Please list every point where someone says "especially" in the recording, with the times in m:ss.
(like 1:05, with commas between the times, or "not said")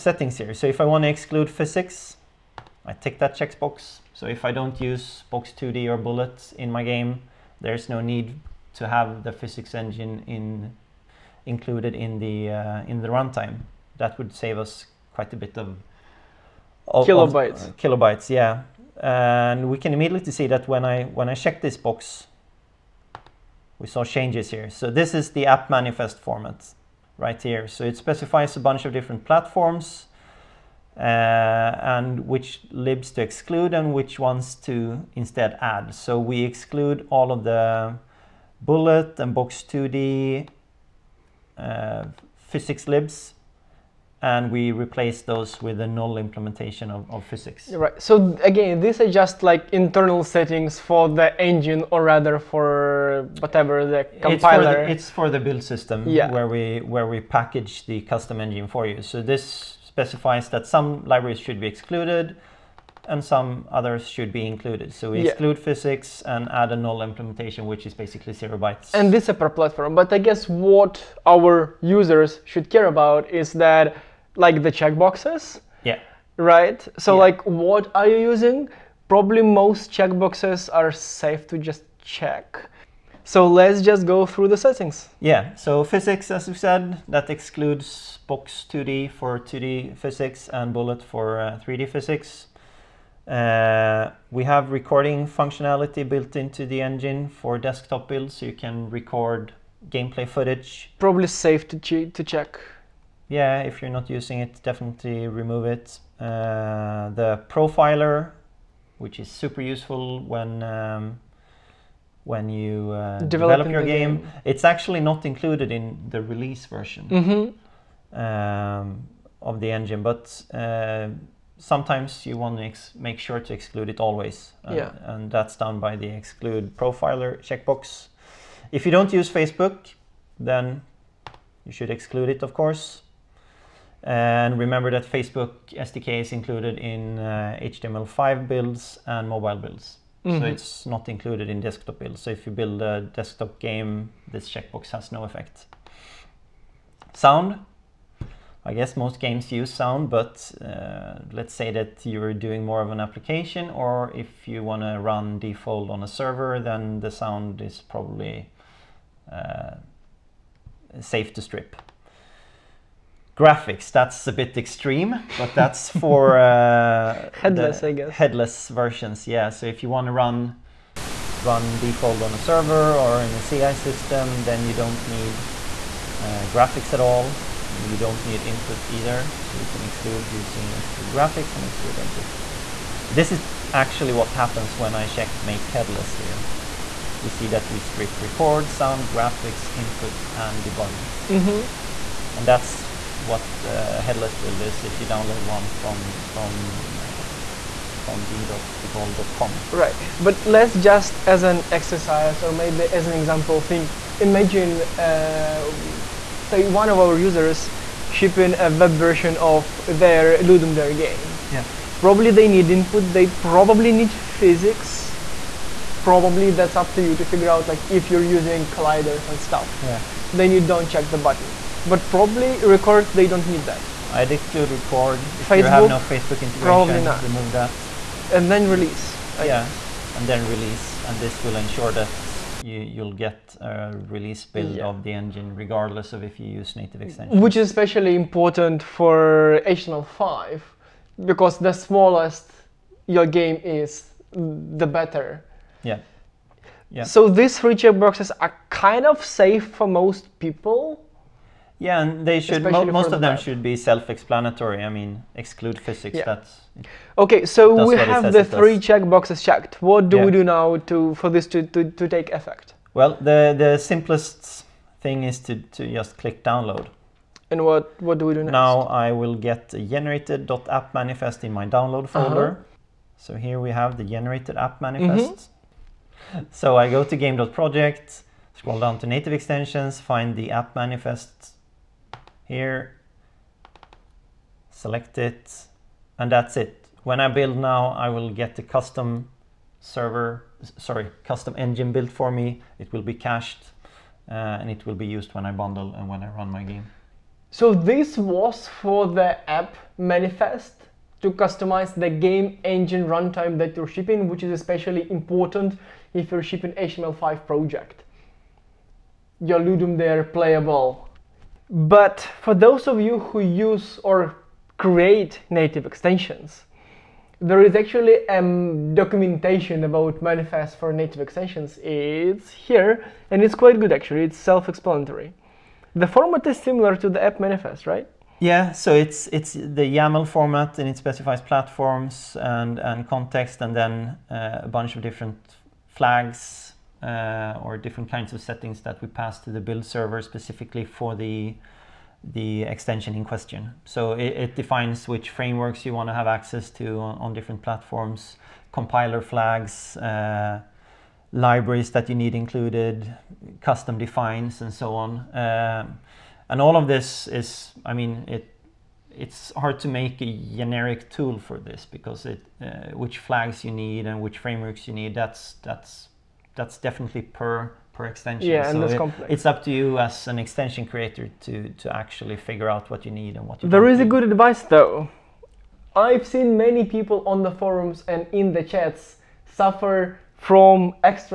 3:57, 5:04.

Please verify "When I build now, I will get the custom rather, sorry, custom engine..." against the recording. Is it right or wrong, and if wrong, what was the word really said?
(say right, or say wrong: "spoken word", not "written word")
wrong: "server", not "rather".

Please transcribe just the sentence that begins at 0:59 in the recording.
So this specifies that some libraries should be excluded and some others should be included.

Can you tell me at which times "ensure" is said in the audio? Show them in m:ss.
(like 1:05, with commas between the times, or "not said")
3:51.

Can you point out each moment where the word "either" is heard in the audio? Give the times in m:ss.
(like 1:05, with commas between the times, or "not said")
2:58.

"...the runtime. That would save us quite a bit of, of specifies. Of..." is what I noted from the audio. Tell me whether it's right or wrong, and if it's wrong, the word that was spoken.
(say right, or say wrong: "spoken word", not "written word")
wrong: "kilobytes", not "specifies".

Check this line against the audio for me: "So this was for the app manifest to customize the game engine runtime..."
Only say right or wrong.
right.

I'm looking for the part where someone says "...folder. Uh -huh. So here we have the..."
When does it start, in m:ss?
4:32.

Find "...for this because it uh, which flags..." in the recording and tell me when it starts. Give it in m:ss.
6:01.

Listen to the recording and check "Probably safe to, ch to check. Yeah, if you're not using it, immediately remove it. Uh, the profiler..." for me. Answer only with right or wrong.
wrong.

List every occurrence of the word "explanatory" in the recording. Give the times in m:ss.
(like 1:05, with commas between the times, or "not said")
4:13, 5:24.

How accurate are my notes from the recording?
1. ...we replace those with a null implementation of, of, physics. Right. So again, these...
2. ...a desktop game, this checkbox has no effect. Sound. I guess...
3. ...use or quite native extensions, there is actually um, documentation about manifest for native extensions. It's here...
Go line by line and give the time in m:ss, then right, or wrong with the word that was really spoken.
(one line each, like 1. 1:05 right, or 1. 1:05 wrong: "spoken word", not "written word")
1. 0:44 right
2. 2:22 right
3. 5:13 wrong: "create", not "quite".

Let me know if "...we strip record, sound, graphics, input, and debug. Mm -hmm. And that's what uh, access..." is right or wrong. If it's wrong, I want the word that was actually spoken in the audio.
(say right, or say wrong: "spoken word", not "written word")
wrong: "headless", not "access".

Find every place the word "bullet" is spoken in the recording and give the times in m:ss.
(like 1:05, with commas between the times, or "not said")
0:05, 0:38, 1:30.